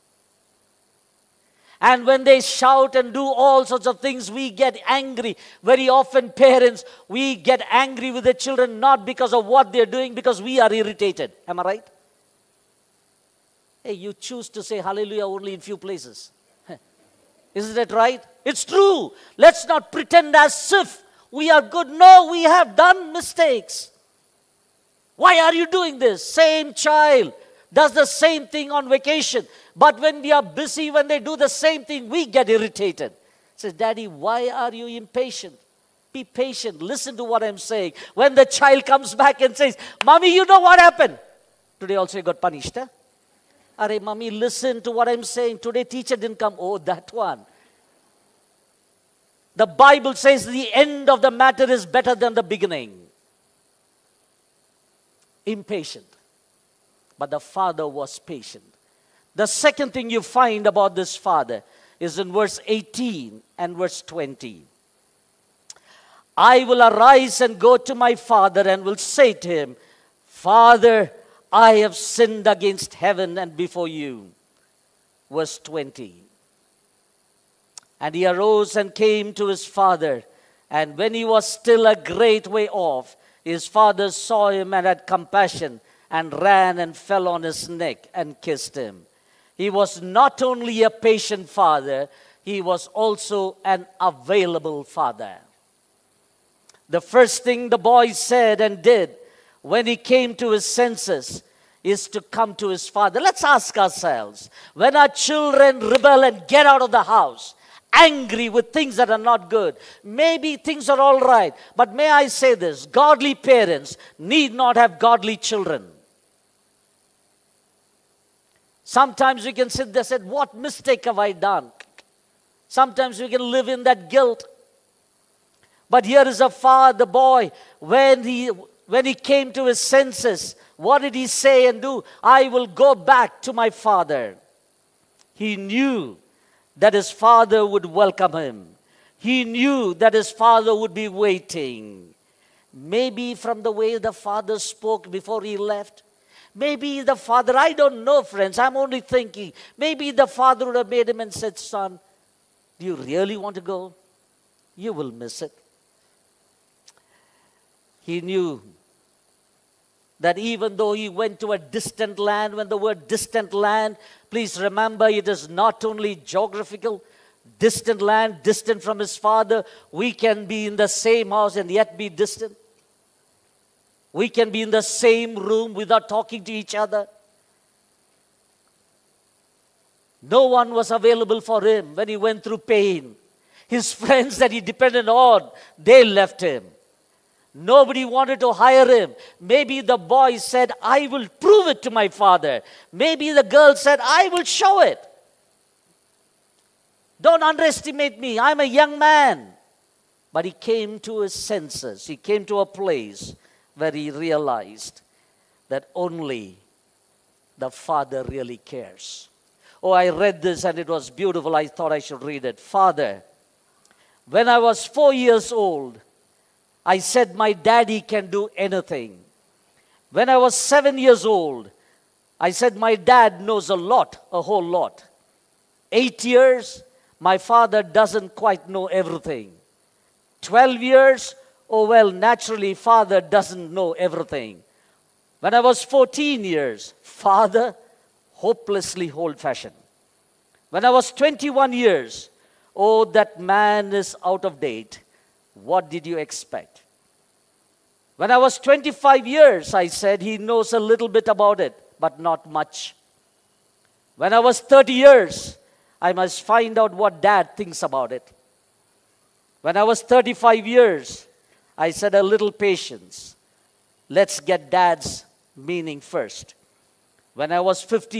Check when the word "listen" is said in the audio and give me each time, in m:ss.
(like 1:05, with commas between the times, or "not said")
0:36, 0:44.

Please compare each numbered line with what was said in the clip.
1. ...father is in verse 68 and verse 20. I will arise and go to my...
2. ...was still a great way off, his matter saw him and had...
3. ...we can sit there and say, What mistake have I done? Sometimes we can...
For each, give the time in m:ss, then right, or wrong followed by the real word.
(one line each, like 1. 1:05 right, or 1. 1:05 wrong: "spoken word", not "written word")
1. 1:01 wrong: "18", not "68"
2. 1:21 wrong: "father", not "matter"
3. 1:59 right.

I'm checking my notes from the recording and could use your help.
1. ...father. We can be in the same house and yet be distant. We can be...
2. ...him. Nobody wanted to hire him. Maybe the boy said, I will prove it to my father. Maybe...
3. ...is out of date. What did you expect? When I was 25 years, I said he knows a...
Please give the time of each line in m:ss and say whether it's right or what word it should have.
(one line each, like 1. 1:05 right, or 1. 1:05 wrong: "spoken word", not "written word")
1. 2:49 right
2. 3:06 right
3. 4:03 right.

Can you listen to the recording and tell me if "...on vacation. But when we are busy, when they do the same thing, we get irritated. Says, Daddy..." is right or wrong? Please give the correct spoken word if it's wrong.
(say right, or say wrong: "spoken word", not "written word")
right.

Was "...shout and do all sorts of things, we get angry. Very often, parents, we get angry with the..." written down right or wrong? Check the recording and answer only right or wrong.
right.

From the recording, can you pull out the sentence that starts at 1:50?
Maybe things are all right, but may I say this godly parents need not have godly children.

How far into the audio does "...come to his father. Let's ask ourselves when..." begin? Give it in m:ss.
1:42.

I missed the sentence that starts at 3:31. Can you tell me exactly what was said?
I thought I should read it.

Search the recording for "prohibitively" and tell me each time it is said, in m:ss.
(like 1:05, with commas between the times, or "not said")
not said.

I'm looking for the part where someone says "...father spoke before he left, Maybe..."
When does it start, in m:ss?
2:24.